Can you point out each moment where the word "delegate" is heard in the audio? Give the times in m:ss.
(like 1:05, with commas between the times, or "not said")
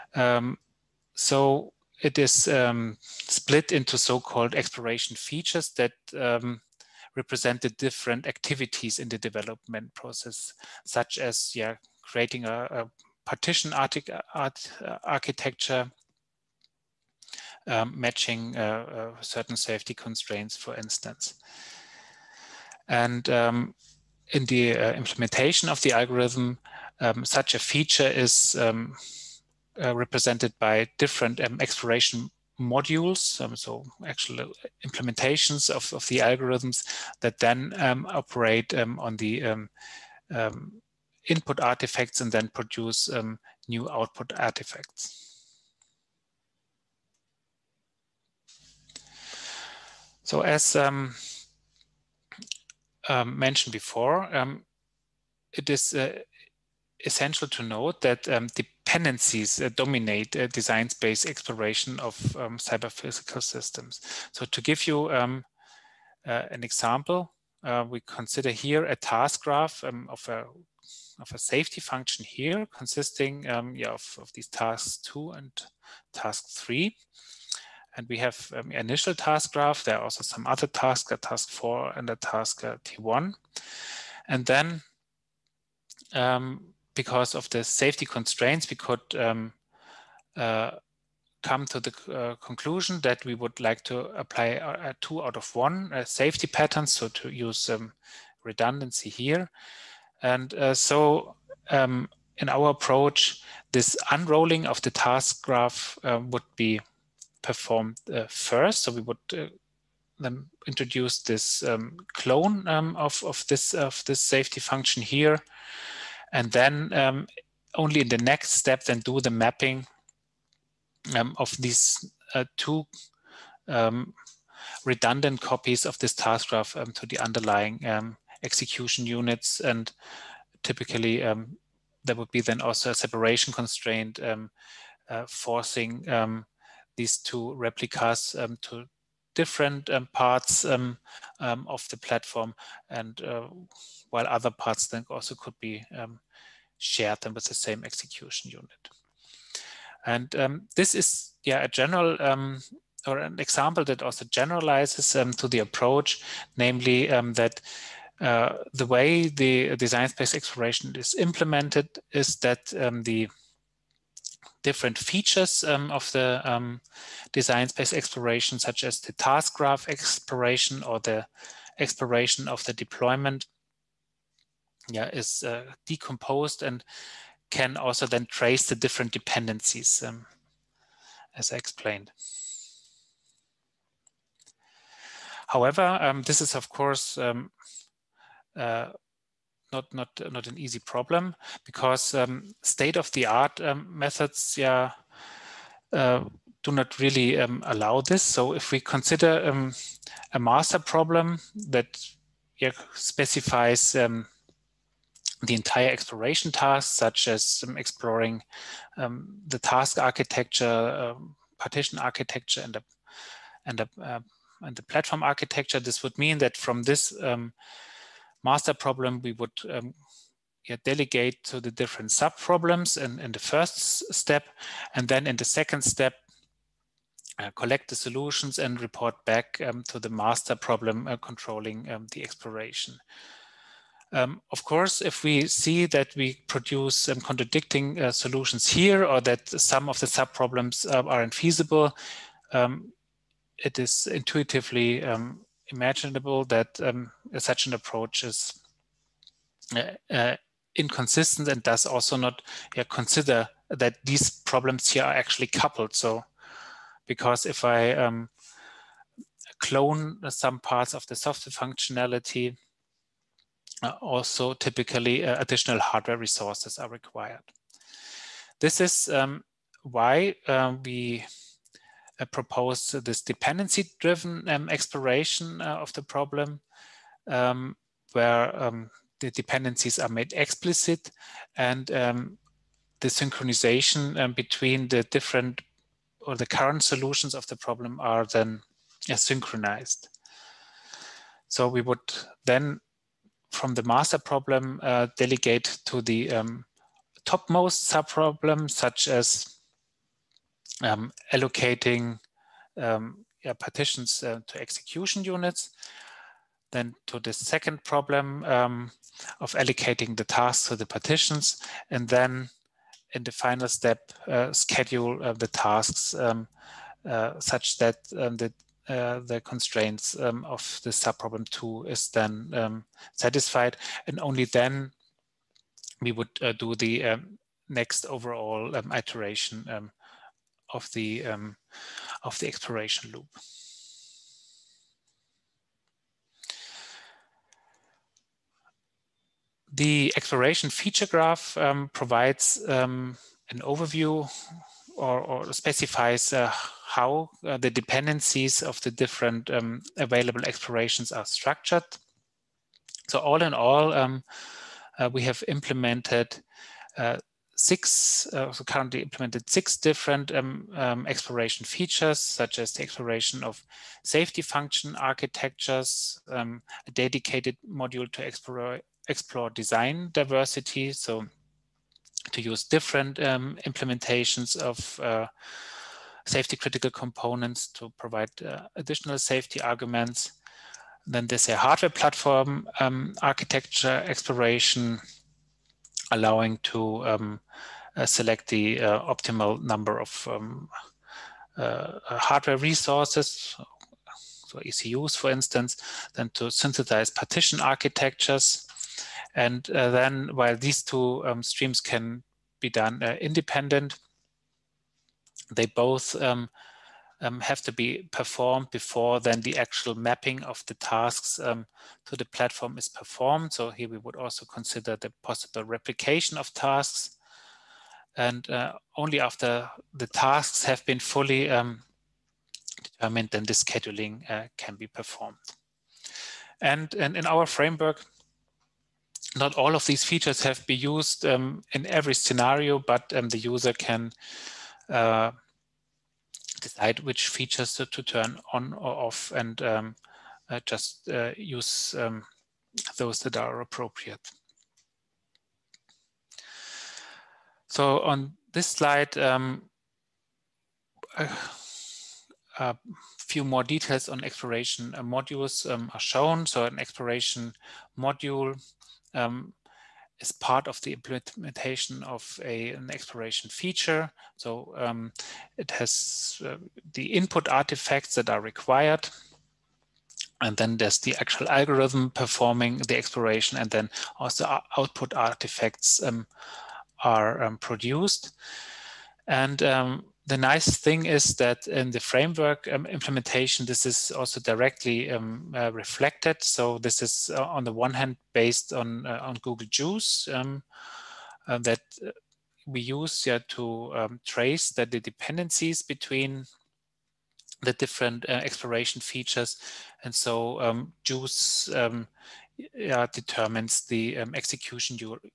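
3:40, 4:55.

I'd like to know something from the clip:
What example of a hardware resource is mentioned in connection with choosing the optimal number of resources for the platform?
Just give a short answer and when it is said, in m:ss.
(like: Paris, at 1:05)
ECUs, at 6:34.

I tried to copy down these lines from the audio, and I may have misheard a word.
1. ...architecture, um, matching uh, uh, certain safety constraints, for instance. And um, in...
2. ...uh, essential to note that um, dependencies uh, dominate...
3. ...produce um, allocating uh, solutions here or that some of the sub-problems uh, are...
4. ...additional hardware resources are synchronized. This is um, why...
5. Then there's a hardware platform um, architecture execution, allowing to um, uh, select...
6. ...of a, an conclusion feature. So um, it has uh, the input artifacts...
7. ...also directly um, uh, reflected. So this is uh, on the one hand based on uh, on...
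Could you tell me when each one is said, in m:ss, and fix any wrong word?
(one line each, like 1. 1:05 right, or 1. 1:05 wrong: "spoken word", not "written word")
1. 0:15 right
2. 0:55 right
3. 3:56 wrong: "contradicting", not "allocating"
4. 4:25 wrong: "required", not "synchronized"
5. 6:21 wrong: "exploration", not "execution"
6. 7:42 wrong: "exploration", not "conclusion"
7. 8:04 right.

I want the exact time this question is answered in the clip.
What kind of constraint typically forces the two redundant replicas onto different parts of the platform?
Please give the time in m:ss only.
2:12.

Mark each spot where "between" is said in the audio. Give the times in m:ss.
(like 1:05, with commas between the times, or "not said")
4:44, 8:15.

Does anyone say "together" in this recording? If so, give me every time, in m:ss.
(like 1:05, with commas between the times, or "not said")
not said.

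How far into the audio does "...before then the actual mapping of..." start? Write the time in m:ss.
6:48.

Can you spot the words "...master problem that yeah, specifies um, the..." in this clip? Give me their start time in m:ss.
3:20.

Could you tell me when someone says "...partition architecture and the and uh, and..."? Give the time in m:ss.
3:31.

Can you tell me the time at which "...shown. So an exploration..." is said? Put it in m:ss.
7:35.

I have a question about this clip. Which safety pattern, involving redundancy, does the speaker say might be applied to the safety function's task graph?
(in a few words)
Two out of one.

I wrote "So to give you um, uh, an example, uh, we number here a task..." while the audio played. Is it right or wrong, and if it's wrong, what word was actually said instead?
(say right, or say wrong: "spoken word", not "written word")
wrong: "consider", not "number".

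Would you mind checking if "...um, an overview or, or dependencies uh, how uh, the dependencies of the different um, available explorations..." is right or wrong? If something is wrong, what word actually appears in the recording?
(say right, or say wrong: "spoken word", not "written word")
wrong: "specifies", not "dependencies".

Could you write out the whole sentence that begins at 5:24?
And only then we would uh, do the next overall iteration of the, um, of the exploration loop.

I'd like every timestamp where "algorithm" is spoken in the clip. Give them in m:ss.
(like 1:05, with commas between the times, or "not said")
0:25, 0:36, 7:51.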